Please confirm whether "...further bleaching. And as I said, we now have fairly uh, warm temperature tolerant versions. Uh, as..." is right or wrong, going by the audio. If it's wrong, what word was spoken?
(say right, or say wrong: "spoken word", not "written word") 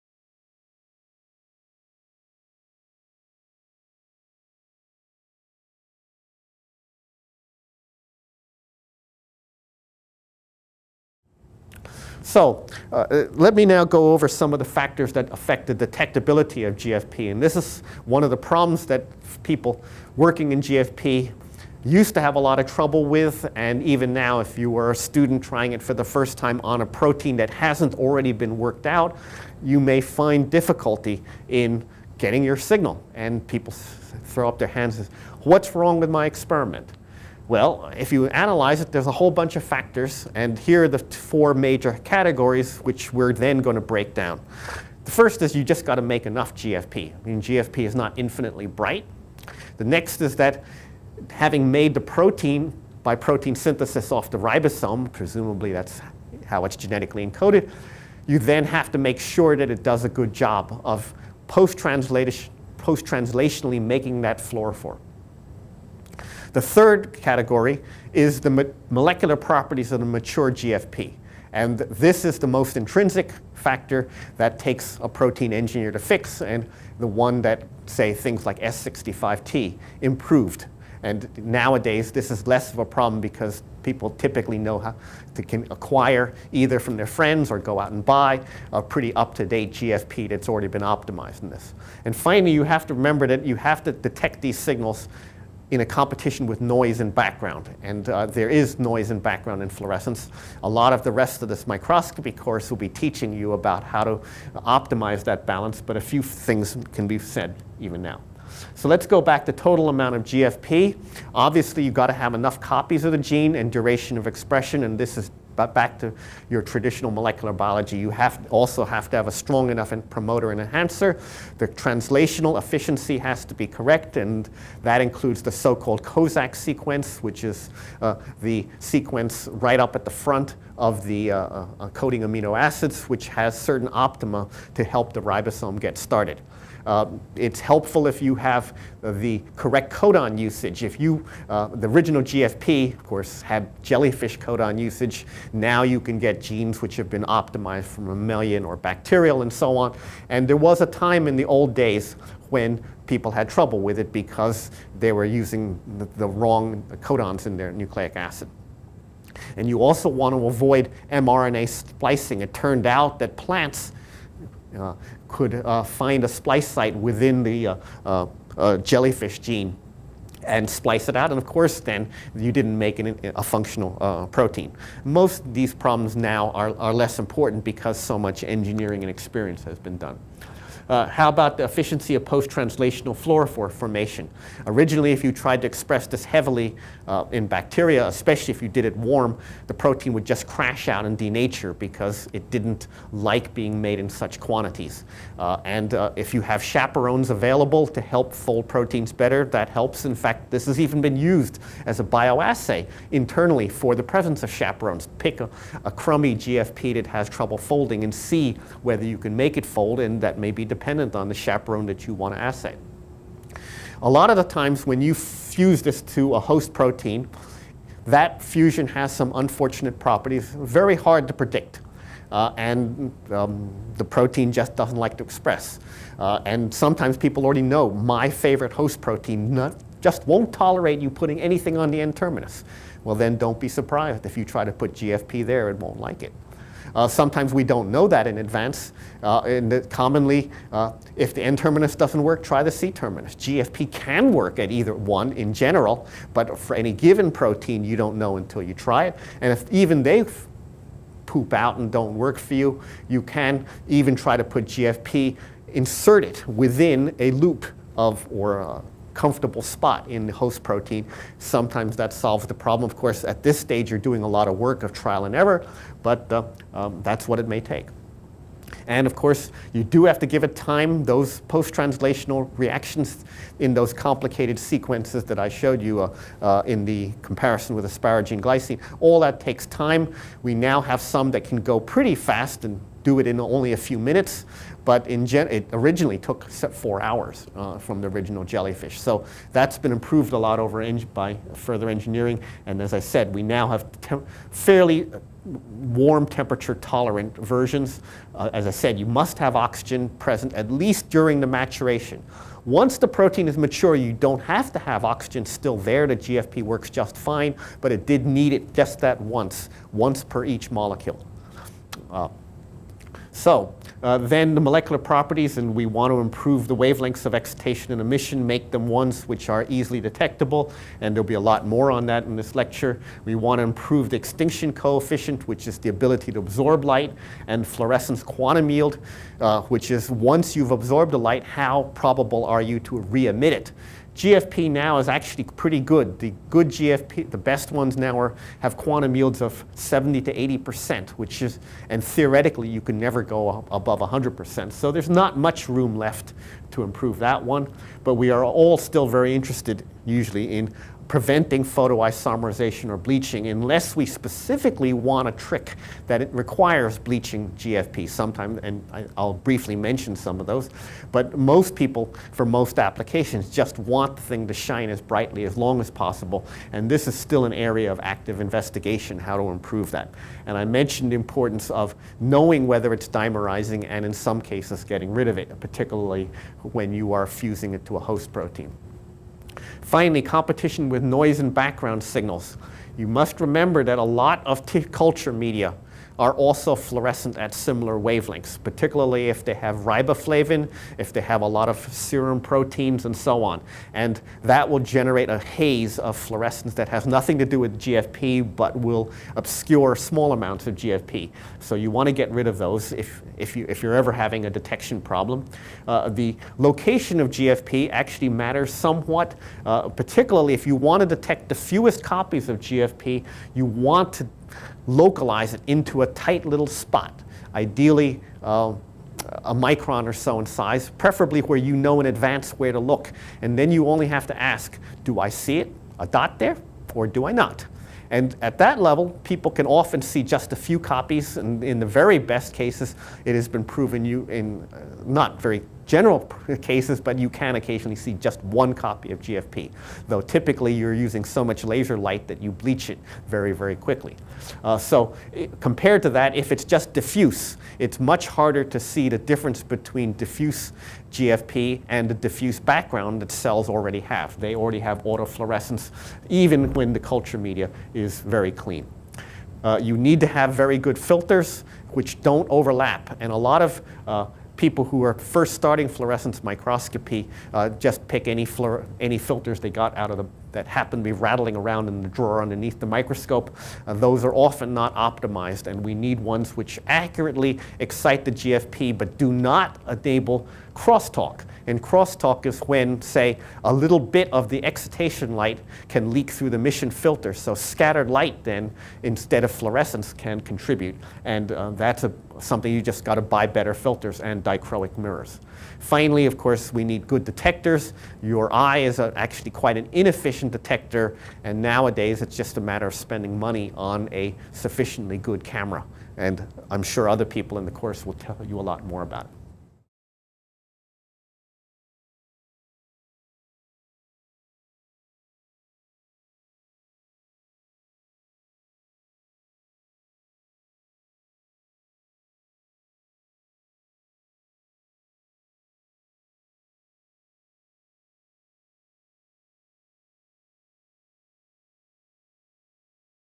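wrong: "engineering", not "bleaching".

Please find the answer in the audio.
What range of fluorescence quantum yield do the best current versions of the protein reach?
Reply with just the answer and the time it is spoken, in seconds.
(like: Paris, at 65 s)
70 to 80 percent, at 339 s.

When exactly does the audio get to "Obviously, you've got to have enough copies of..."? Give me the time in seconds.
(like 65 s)
111 s.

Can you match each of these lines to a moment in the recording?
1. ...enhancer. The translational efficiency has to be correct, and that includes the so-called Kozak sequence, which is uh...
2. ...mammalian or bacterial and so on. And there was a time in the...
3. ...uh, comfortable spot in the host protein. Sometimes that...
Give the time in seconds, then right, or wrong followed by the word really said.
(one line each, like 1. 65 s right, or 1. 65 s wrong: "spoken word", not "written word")
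1. 120 s right
2. 148 s right
3. 258 s right.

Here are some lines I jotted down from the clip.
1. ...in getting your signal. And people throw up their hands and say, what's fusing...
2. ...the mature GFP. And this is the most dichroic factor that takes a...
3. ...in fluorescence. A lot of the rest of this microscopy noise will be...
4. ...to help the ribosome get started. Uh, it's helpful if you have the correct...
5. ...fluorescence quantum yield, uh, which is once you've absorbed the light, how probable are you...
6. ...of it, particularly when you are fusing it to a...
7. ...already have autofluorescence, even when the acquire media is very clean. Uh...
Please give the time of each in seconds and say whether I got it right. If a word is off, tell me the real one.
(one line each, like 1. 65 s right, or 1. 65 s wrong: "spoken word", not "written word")
1. 31 s wrong: "wrong", not "fusing"
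2. 70 s wrong: "intrinsic", not "dichroic"
3. 99 s wrong: "course", not "noise"
4. 134 s right
5. 327 s right
6. 375 s right
7. 454 s wrong: "culture", not "acquire".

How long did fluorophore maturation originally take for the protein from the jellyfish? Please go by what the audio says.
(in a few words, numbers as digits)
4 hours.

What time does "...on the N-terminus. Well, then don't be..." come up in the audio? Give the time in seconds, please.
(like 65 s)
231 s.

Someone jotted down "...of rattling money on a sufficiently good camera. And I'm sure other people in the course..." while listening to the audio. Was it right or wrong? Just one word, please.
wrong.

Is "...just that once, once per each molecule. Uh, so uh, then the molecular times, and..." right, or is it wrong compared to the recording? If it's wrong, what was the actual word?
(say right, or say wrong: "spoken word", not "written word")
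wrong: "properties", not "times".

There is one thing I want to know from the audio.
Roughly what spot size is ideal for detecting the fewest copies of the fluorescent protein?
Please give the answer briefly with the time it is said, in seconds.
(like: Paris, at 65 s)
A micron, at 419 s.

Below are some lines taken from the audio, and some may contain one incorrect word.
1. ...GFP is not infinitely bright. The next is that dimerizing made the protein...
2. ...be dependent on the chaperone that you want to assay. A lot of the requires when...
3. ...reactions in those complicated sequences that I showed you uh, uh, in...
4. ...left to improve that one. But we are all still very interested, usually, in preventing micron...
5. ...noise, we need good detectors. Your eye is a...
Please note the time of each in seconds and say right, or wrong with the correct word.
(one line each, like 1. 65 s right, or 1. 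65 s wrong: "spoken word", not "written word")
1. 47 s wrong: "having", not "dimerizing"
2. 210 s wrong: "times", not "requires"
3. 272 s right
4. 345 s wrong: "photoisomerization", not "micron"
5. 496 s wrong: "course", not "noise".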